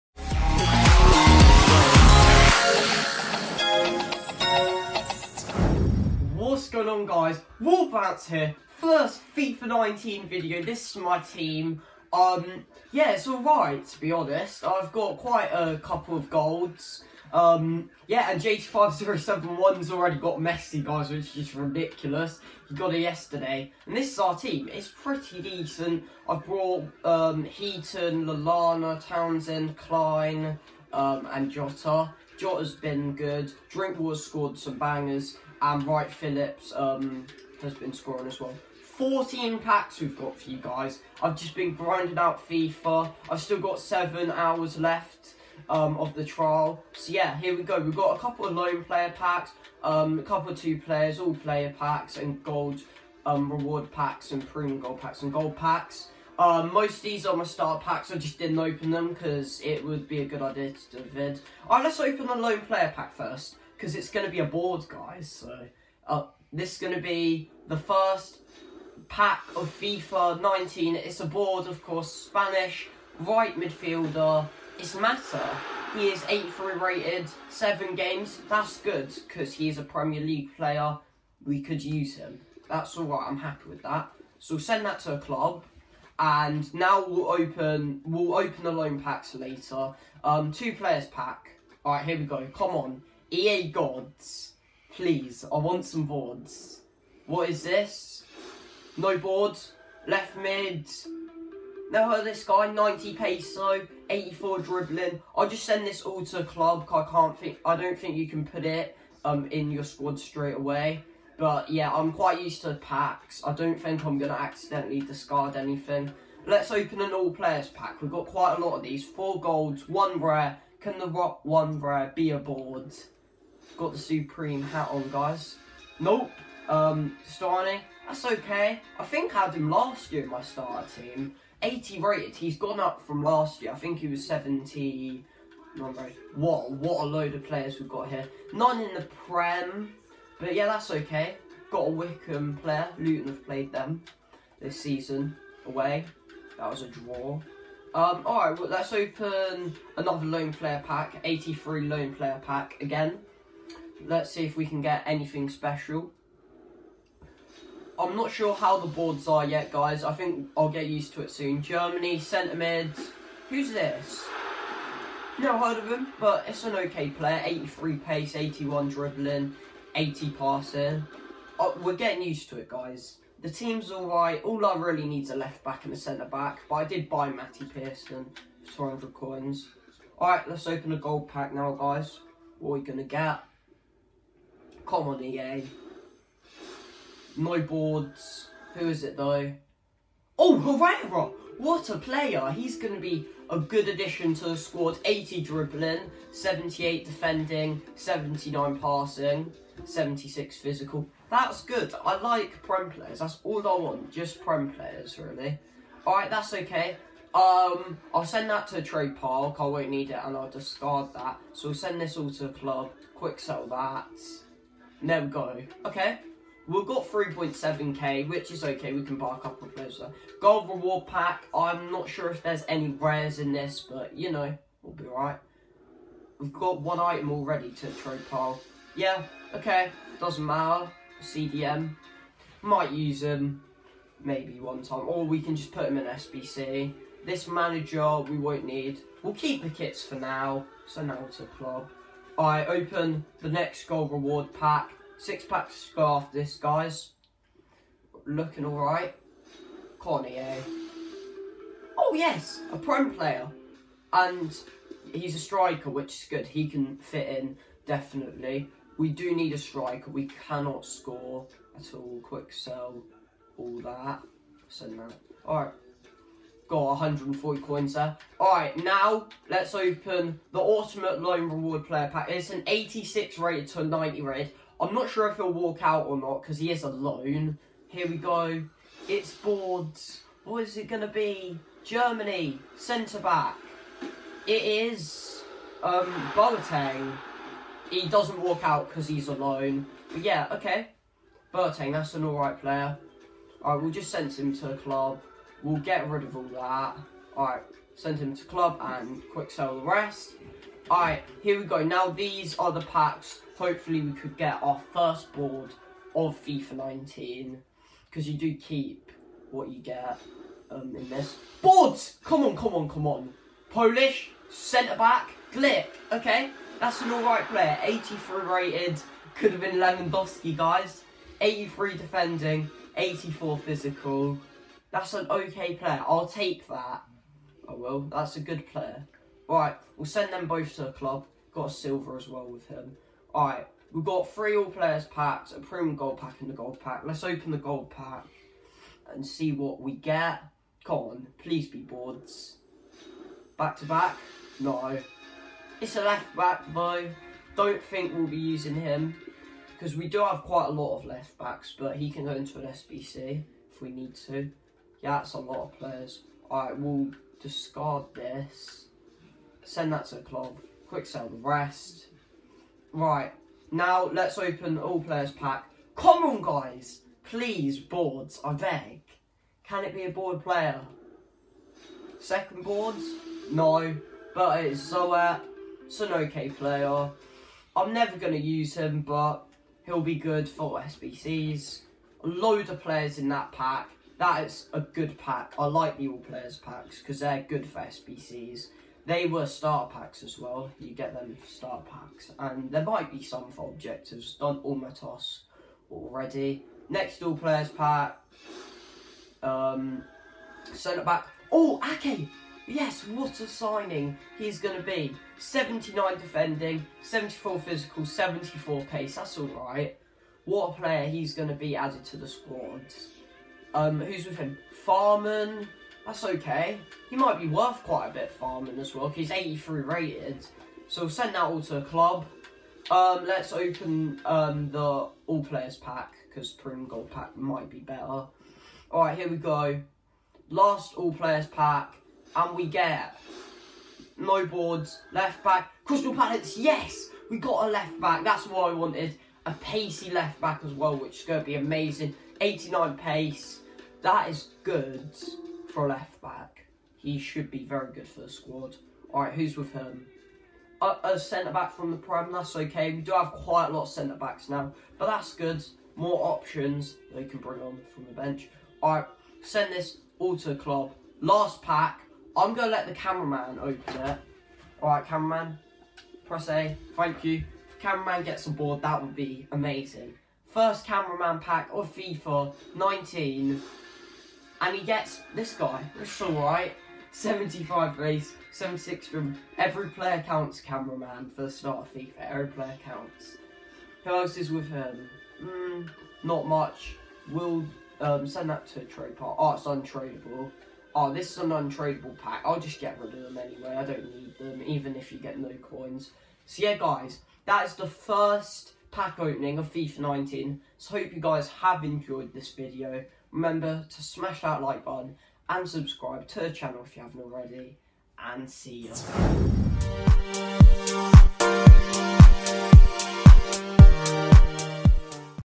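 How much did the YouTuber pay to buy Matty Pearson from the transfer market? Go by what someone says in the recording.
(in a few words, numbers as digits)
400 coins.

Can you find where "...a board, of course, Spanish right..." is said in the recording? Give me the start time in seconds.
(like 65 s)
71 s.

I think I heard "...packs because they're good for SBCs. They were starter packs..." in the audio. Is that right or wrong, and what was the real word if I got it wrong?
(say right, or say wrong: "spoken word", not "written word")
right.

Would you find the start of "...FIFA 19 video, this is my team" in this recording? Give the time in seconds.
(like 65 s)
9 s.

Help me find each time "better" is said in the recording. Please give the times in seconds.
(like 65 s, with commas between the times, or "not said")
427 s.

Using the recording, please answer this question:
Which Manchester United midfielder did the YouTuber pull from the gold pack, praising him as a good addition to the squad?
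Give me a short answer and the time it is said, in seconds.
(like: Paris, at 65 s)
Herrera, at 190 s.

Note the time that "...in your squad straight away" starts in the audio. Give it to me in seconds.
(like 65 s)
109 s.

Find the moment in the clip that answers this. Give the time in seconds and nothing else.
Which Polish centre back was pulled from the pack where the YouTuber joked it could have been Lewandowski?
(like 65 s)
315 s.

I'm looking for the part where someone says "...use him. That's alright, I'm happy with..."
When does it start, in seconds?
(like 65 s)
81 s.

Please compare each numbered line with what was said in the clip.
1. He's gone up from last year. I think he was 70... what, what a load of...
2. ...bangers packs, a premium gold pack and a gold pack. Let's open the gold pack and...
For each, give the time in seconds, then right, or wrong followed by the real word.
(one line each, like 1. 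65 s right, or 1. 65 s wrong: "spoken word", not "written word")
1. 132 s right
2. 334 s wrong: "players", not "bangers".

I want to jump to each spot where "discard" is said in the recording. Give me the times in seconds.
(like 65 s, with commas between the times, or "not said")
114 s, 210 s, 357 s.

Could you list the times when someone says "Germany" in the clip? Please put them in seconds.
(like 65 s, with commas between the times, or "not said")
161 s, 281 s.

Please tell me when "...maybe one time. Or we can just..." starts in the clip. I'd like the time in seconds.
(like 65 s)
234 s.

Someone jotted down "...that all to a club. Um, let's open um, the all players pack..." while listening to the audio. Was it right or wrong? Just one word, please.
right.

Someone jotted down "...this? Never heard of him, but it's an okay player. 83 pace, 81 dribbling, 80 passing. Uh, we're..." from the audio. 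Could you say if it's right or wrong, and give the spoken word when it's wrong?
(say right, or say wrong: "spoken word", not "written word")
right.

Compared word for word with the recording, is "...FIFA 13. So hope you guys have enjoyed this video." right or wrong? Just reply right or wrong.
wrong.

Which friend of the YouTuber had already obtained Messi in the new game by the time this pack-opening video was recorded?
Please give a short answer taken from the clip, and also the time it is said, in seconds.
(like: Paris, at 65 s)
JT5071, at 18 s.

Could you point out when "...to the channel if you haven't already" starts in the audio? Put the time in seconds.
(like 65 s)
506 s.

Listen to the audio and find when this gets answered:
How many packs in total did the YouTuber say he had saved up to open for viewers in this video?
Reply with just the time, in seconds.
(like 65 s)
38 s.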